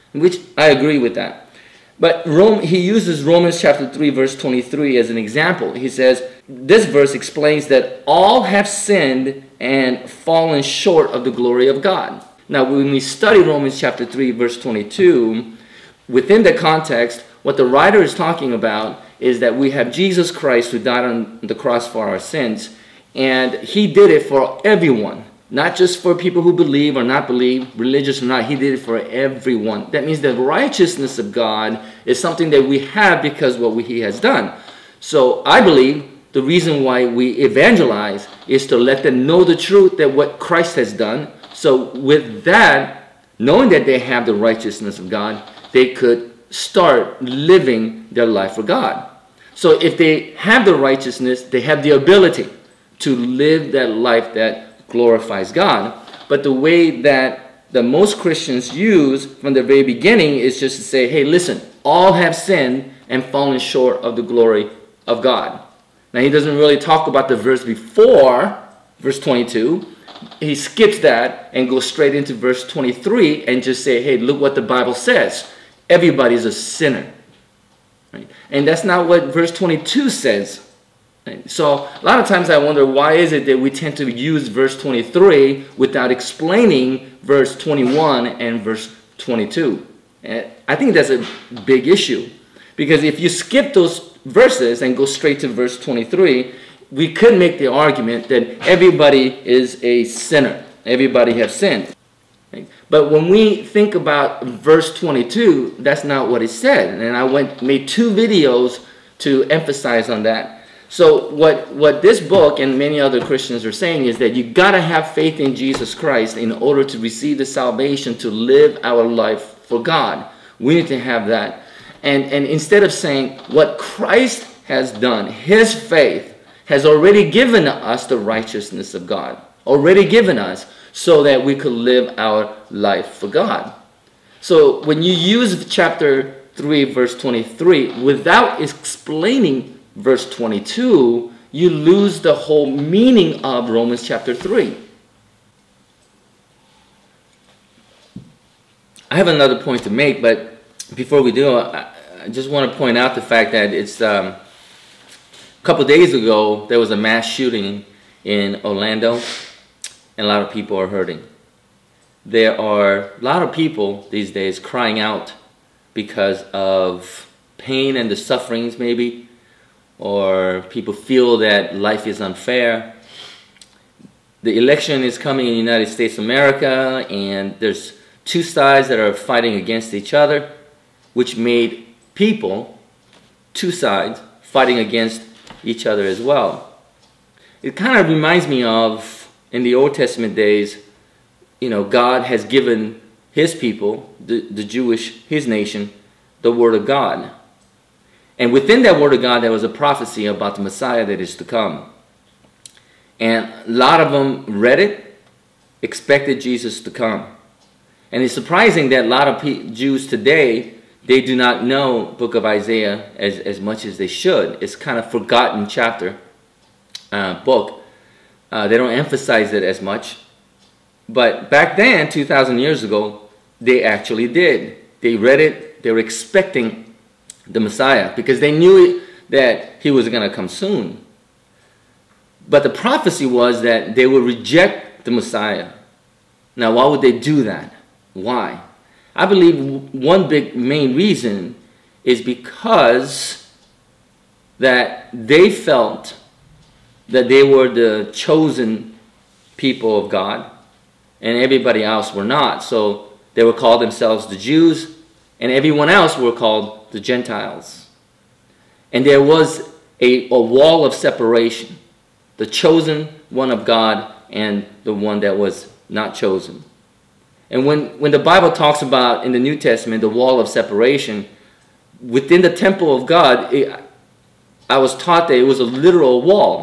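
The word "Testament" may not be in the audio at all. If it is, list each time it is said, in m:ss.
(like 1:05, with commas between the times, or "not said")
3:09, 4:29.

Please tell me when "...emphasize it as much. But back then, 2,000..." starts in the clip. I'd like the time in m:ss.
3:38.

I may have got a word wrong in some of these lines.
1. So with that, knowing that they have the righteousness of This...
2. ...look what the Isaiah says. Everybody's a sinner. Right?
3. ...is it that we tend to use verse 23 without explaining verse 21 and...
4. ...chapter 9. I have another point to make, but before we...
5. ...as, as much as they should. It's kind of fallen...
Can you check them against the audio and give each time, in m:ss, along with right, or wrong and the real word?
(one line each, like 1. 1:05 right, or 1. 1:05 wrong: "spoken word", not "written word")
1. 0:41 wrong: "God", not "This"
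2. 1:14 wrong: "Bible", not "Isaiah"
3. 1:23 right
4. 2:24 wrong: "3", not "9"
5. 3:33 wrong: "forgotten", not "fallen".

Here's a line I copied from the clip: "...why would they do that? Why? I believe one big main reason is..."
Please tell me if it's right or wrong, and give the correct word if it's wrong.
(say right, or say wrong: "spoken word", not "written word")
right.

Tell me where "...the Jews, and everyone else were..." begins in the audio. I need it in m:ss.
4:14.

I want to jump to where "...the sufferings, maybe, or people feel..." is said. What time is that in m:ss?
2:48.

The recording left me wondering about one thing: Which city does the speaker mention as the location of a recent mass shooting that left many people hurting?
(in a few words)
Orlando.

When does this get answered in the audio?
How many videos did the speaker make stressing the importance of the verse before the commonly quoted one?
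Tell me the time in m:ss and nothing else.
1:47.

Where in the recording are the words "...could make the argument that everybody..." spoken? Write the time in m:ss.
1:37.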